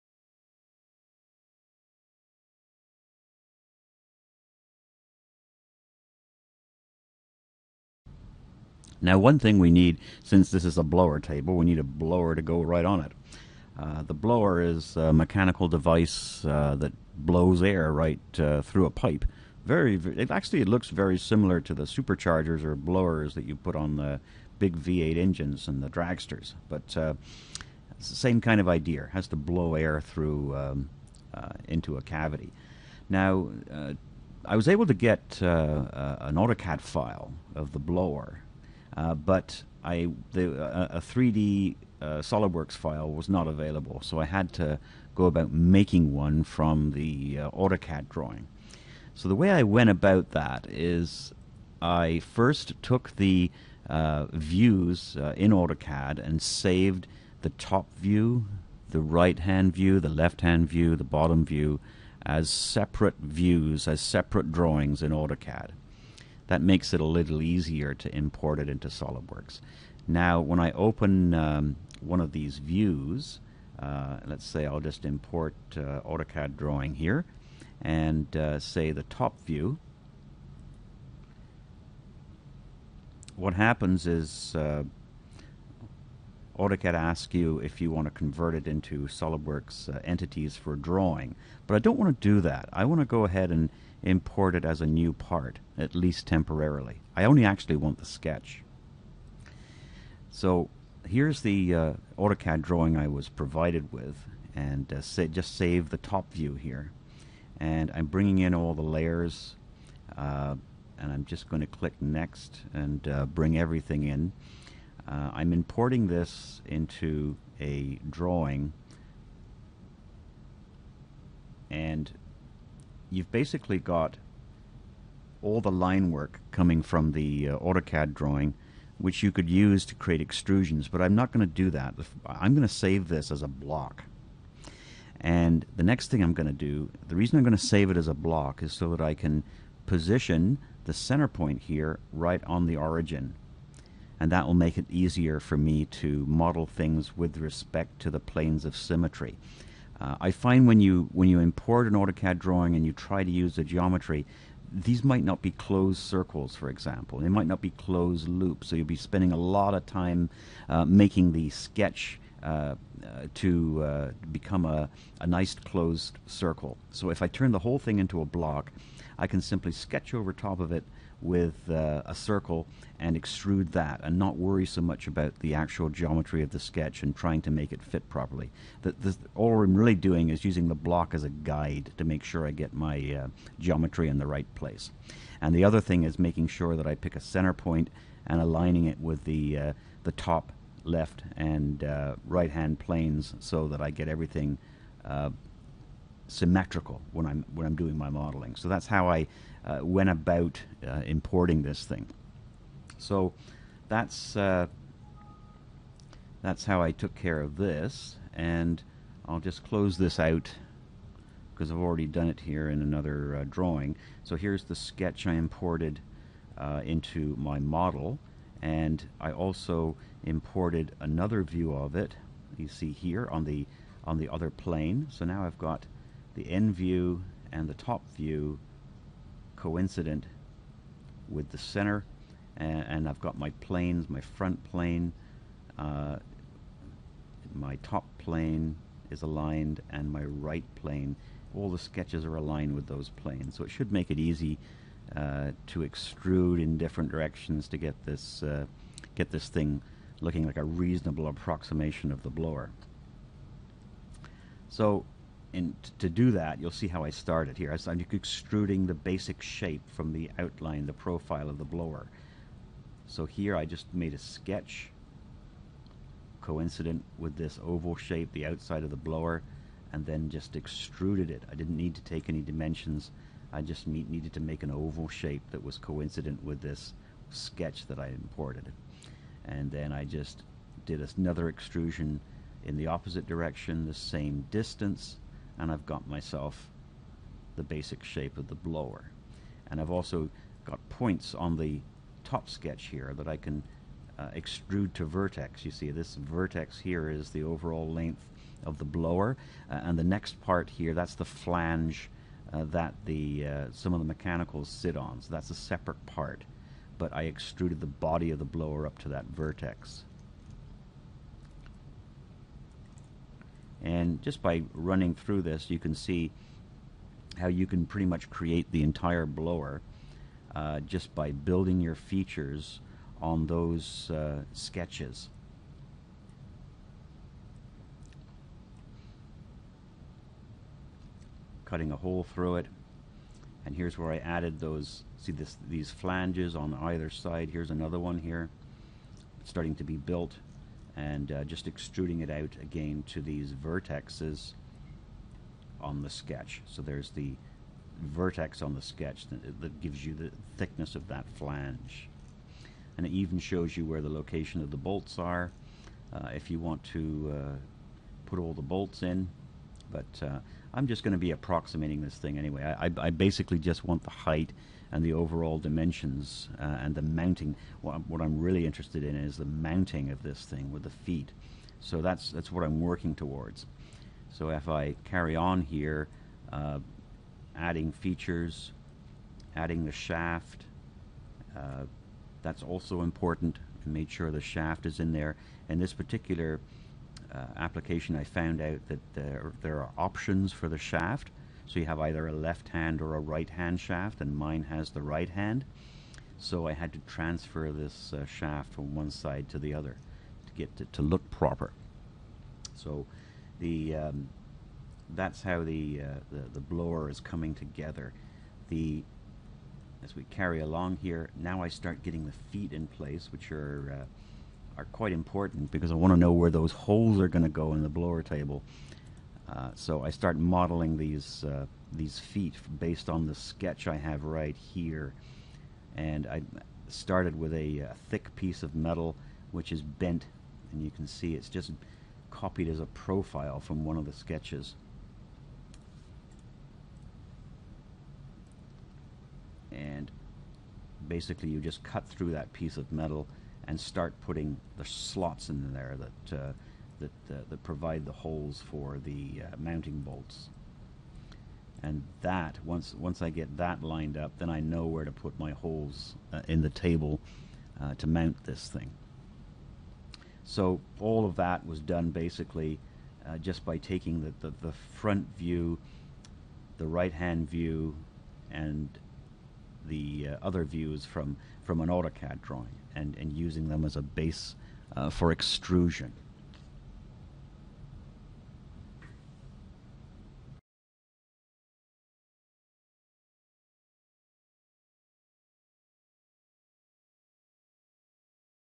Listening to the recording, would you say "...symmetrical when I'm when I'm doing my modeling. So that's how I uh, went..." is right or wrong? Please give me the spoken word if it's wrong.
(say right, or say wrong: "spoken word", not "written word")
right.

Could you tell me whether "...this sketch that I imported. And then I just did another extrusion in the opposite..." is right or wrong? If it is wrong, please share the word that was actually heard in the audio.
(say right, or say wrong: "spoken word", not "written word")
right.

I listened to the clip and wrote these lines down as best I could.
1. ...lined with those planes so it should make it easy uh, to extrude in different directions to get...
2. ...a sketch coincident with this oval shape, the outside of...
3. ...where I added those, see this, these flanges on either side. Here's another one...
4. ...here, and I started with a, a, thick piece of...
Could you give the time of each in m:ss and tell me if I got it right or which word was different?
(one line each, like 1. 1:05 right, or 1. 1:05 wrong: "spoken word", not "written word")
1. 4:02 wrong: "aligned", not "lined"
2. 4:24 right
3. 5:33 right
4. 7:04 right.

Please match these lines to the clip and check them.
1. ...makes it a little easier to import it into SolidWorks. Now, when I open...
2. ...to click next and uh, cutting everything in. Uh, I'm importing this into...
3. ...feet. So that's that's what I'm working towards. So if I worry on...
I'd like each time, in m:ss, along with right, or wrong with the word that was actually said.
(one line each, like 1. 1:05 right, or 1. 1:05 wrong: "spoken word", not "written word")
1. 1:06 right
2. 1:51 wrong: "bring", not "cutting"
3. 6:10 wrong: "carry", not "worry".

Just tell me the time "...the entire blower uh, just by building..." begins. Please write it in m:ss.
5:18.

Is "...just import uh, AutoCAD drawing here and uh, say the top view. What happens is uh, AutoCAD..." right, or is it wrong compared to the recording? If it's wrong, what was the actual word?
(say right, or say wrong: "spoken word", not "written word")
right.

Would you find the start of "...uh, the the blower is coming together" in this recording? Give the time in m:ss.
6:46.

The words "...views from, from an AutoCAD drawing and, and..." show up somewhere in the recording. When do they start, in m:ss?
7:50.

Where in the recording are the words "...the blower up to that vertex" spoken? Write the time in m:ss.
5:08.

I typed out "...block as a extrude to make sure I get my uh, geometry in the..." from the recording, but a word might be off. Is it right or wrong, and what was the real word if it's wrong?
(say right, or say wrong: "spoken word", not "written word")
wrong: "guide", not "extrude".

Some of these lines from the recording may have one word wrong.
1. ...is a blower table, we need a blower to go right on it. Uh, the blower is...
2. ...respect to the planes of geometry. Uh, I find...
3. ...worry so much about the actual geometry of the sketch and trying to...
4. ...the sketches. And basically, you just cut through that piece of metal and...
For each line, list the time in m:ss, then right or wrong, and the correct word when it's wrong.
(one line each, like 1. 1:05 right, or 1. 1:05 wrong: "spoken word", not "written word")
1. 0:10 right
2. 2:27 wrong: "symmetry", not "geometry"
3. 2:54 right
4. 7:14 right.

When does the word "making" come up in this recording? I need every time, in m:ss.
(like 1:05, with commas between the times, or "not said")
0:45, 2:40, 3:06.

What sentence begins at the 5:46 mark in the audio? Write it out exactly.
So there's the vertex on the sketch that, that gives you the thickness of that flange.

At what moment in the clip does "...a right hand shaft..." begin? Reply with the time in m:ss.
6:33.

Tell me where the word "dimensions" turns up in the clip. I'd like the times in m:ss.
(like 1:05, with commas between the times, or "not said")
4:32, 6:05.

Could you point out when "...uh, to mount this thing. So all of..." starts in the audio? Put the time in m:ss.
7:37.